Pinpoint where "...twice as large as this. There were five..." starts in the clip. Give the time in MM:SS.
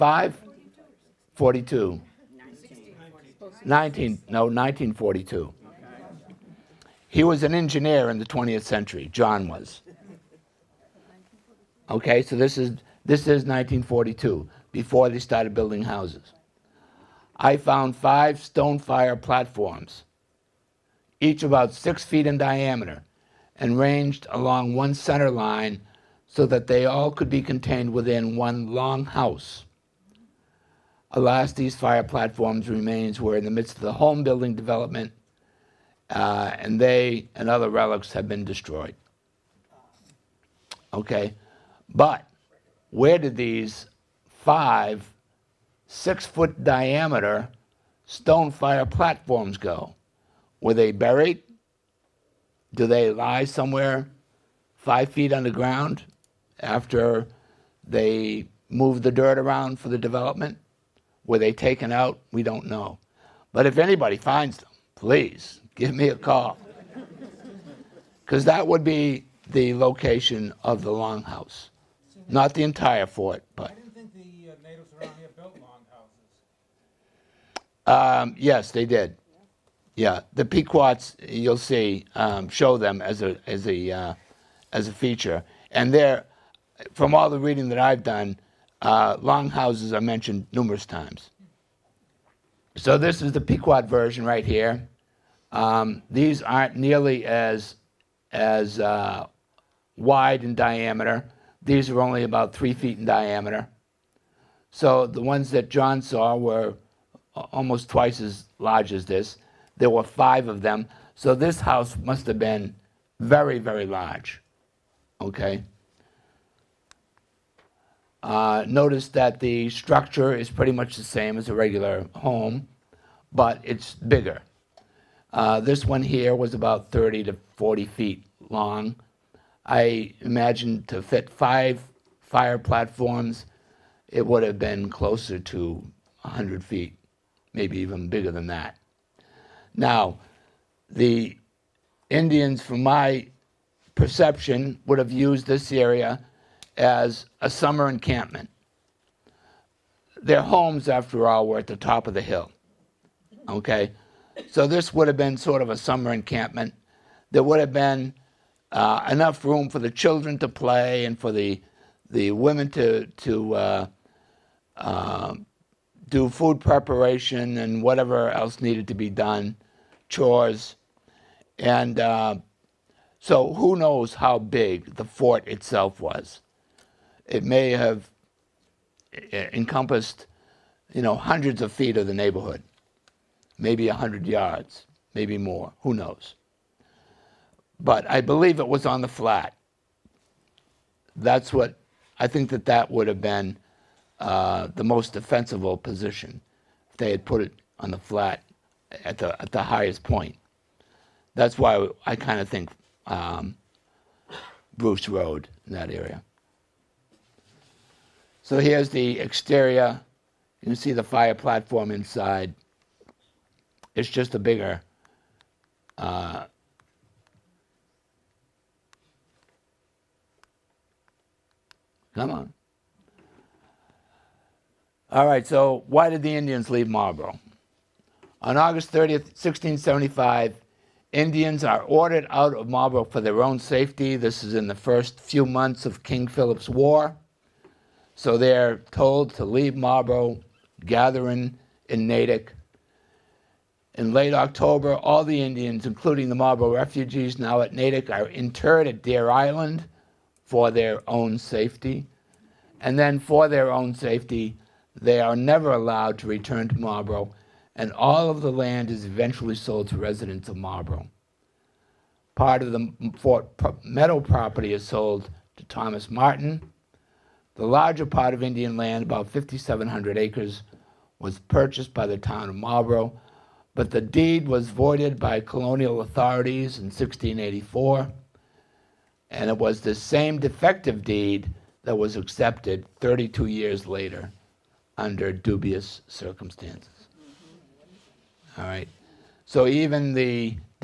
01:47.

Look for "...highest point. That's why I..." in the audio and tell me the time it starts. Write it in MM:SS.
03:19.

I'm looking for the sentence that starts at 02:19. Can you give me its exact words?
Now, the Indians, from my perception, would have used this area as a summer encampment.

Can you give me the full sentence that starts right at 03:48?
On August 30th, 1675, Indians are ordered out of Marlborough for their own safety.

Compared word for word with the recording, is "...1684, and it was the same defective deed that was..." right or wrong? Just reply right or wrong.
right.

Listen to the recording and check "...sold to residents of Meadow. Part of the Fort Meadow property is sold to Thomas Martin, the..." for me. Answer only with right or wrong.
wrong.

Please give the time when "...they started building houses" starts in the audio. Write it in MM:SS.
00:15.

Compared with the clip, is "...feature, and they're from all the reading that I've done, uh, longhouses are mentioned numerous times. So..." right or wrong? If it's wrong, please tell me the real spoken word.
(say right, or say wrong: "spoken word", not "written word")
right.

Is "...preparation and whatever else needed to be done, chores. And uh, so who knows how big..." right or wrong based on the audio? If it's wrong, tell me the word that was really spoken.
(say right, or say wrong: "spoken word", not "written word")
right.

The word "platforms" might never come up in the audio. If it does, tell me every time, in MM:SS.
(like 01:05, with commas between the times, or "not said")
00:19, 00:32, 00:48, 02:12, 03:31.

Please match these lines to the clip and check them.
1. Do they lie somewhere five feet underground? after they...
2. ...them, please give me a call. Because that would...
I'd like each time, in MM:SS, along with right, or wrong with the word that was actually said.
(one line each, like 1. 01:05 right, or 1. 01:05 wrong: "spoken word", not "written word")
1. 00:52 right
2. 01:04 right.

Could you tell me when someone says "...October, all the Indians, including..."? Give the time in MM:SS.
04:04.